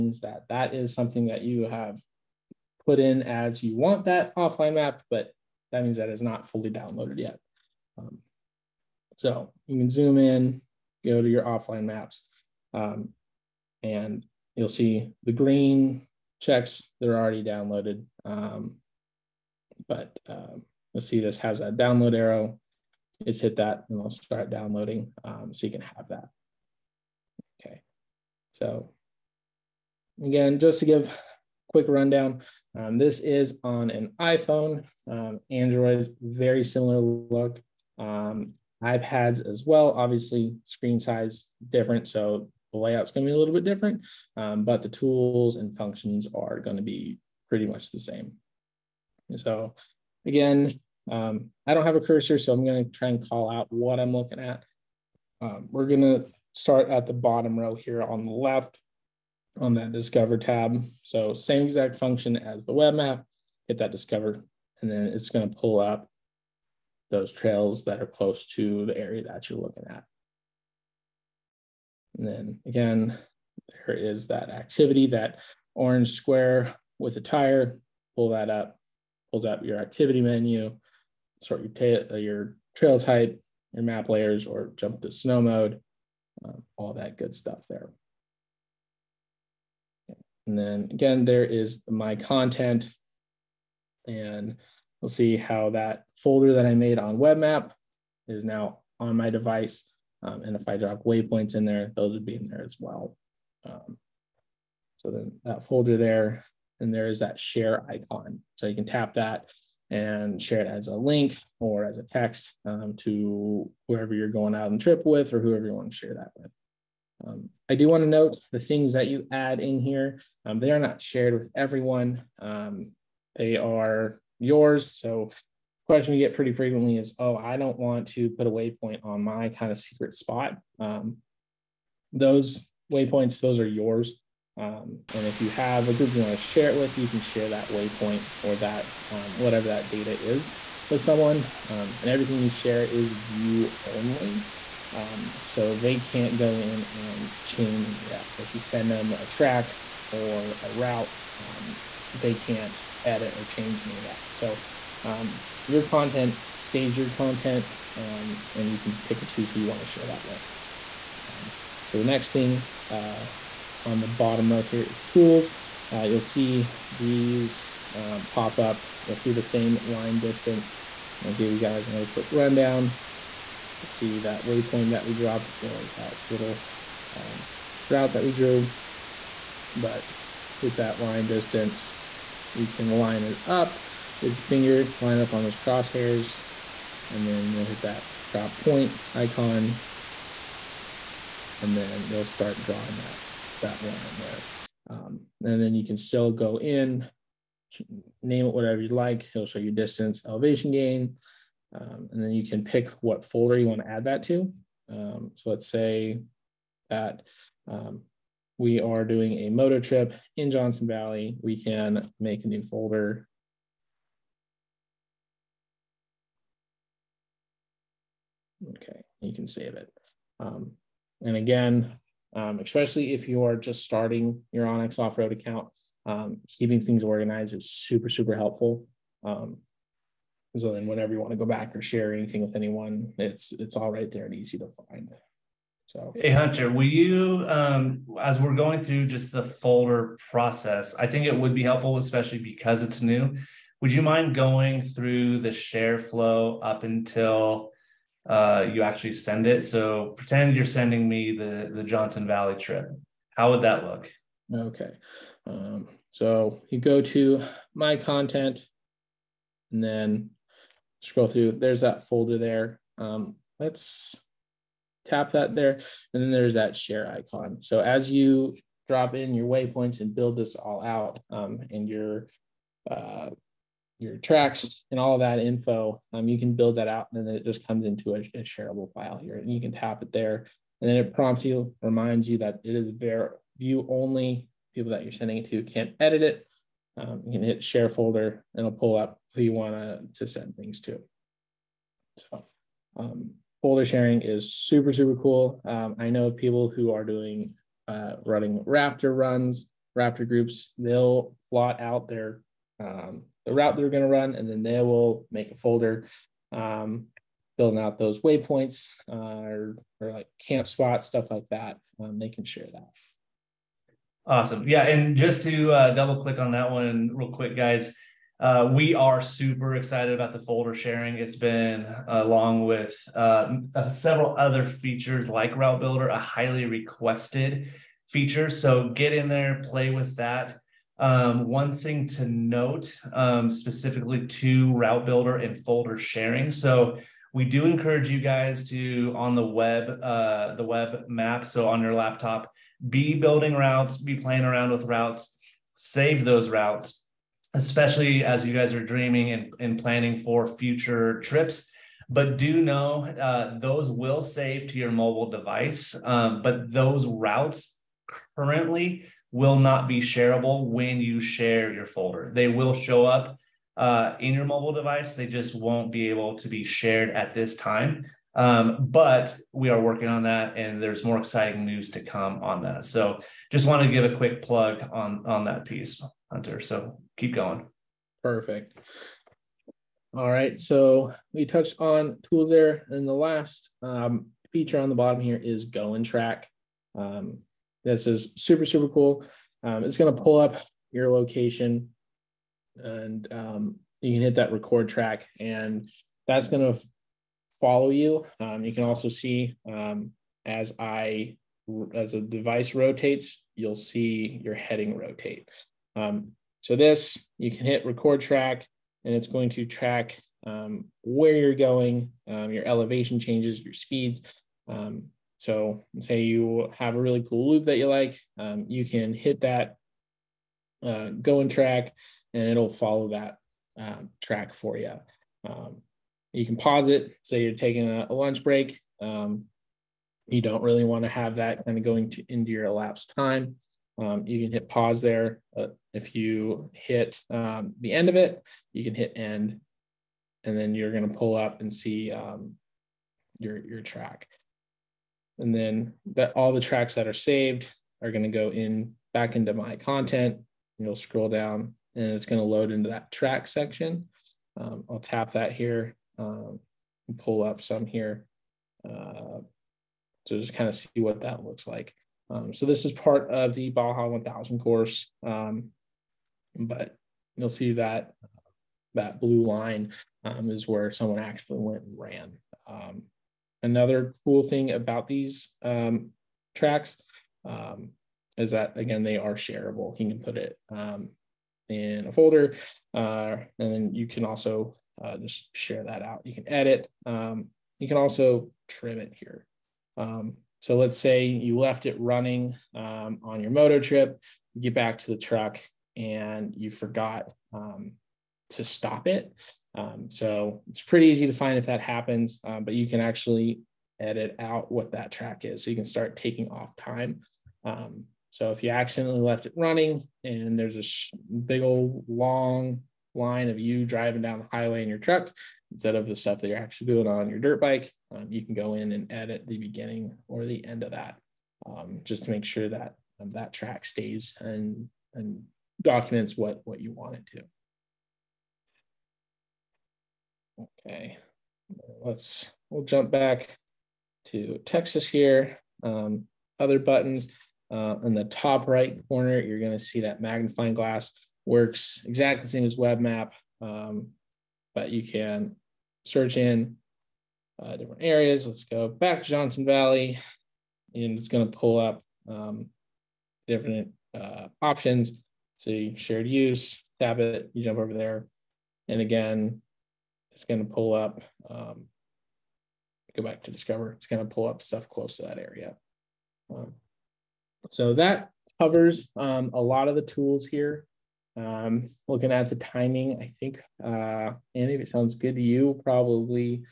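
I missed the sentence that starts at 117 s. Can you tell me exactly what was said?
Um, I do want to note the things that you add in here.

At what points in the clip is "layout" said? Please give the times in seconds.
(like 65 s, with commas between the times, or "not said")
42 s.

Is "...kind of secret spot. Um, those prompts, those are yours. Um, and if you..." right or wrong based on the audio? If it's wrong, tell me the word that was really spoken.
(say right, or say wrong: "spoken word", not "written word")
wrong: "waypoints", not "prompts".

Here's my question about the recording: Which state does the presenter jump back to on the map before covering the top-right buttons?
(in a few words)
Texas.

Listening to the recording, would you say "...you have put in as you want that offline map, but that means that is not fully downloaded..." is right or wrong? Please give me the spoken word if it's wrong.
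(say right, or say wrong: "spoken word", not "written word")
right.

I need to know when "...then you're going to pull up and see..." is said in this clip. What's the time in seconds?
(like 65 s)
440 s.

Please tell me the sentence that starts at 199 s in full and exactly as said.
It'll show you distance, elevation gain, um, and then you can pick what folder you want to add that to.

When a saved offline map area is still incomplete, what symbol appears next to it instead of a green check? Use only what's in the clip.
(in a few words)
Download arrow.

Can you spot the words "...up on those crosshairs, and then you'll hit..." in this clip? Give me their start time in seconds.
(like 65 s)
185 s.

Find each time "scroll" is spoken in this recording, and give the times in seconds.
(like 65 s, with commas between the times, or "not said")
261 s, 450 s.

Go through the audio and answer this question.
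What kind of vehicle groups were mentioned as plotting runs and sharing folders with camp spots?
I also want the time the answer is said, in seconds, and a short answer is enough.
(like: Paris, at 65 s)
Raptor groups, at 299 s.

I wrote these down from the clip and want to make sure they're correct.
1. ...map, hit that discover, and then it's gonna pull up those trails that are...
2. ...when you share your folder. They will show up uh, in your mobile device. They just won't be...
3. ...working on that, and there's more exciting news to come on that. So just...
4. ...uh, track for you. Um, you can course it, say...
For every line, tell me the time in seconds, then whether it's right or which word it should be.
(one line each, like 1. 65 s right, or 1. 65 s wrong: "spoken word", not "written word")
1. 62 s right
2. 360 s right
3. 369 s right
4. 423 s wrong: "pause", not "course".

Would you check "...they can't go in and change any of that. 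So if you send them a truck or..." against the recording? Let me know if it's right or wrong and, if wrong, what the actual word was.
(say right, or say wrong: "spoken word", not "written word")
wrong: "track", not "truck".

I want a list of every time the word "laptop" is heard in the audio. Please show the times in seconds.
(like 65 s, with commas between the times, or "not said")
341 s.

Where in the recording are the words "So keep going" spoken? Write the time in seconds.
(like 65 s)
376 s.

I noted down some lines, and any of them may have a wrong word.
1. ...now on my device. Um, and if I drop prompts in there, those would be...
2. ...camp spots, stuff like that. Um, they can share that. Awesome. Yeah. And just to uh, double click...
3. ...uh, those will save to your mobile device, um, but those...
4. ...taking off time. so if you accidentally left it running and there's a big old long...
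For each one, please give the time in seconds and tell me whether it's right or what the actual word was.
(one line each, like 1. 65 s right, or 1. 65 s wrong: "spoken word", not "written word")
1. 98 s wrong: "waypoints", not "prompts"
2. 310 s right
3. 353 s right
4. 506 s right.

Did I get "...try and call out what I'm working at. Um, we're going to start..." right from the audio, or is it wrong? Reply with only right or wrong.
wrong.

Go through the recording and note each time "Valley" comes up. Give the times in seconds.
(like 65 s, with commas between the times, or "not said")
210 s, 252 s, 549 s.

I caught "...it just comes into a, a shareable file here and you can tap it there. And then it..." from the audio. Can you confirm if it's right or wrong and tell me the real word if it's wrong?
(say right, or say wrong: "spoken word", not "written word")
right.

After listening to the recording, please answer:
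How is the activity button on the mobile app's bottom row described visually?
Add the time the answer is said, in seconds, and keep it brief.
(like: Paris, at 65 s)
Orange square with a tire, at 75 s.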